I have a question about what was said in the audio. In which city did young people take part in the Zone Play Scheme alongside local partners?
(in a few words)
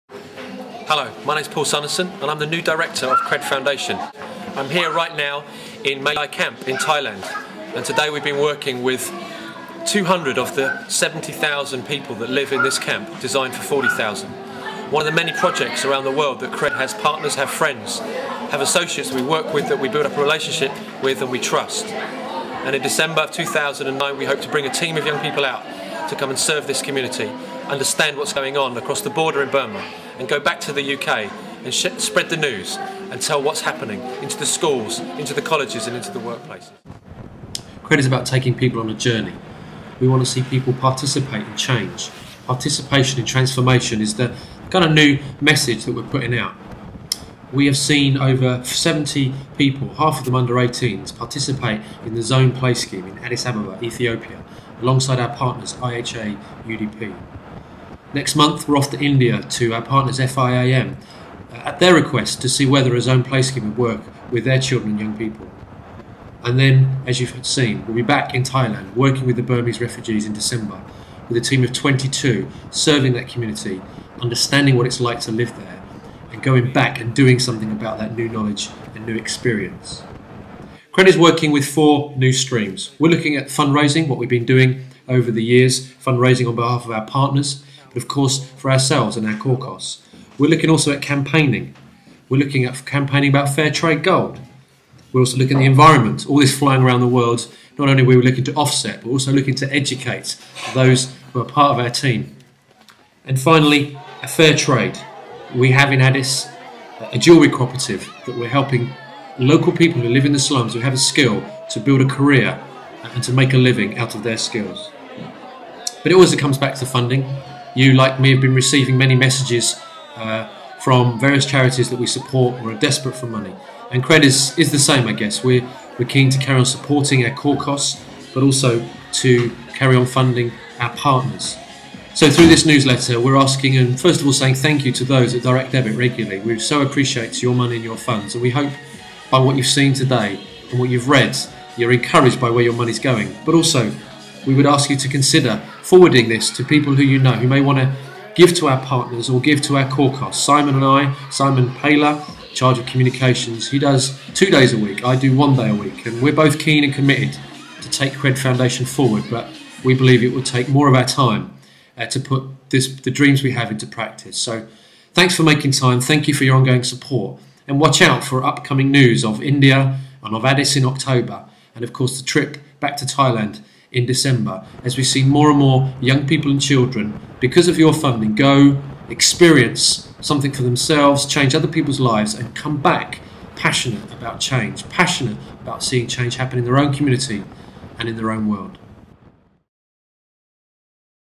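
Addis Ababa.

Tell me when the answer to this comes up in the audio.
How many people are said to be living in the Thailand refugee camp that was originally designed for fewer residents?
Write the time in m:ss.
0:10.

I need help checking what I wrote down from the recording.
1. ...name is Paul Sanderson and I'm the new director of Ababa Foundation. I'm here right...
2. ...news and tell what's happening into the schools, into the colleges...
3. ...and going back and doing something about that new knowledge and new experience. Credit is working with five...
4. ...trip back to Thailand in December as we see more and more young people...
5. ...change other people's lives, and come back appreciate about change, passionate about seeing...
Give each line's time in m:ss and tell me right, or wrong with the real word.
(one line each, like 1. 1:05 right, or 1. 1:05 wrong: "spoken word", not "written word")
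1. 0:01 wrong: "Cred", not "Ababa"
2. 0:32 right
3. 1:16 wrong: "four", not "five"
4. 2:52 right
5. 3:01 wrong: "passionate", not "appreciate".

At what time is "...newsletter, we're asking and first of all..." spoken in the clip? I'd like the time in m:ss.
2:12.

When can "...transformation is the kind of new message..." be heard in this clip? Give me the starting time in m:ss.
0:43.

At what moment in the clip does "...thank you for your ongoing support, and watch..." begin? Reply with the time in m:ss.
2:46.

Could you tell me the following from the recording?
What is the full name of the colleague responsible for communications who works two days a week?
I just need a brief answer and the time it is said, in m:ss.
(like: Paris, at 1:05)
Simon Paylor, at 2:31.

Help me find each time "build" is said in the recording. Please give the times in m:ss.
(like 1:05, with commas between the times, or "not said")
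0:19, 1:51.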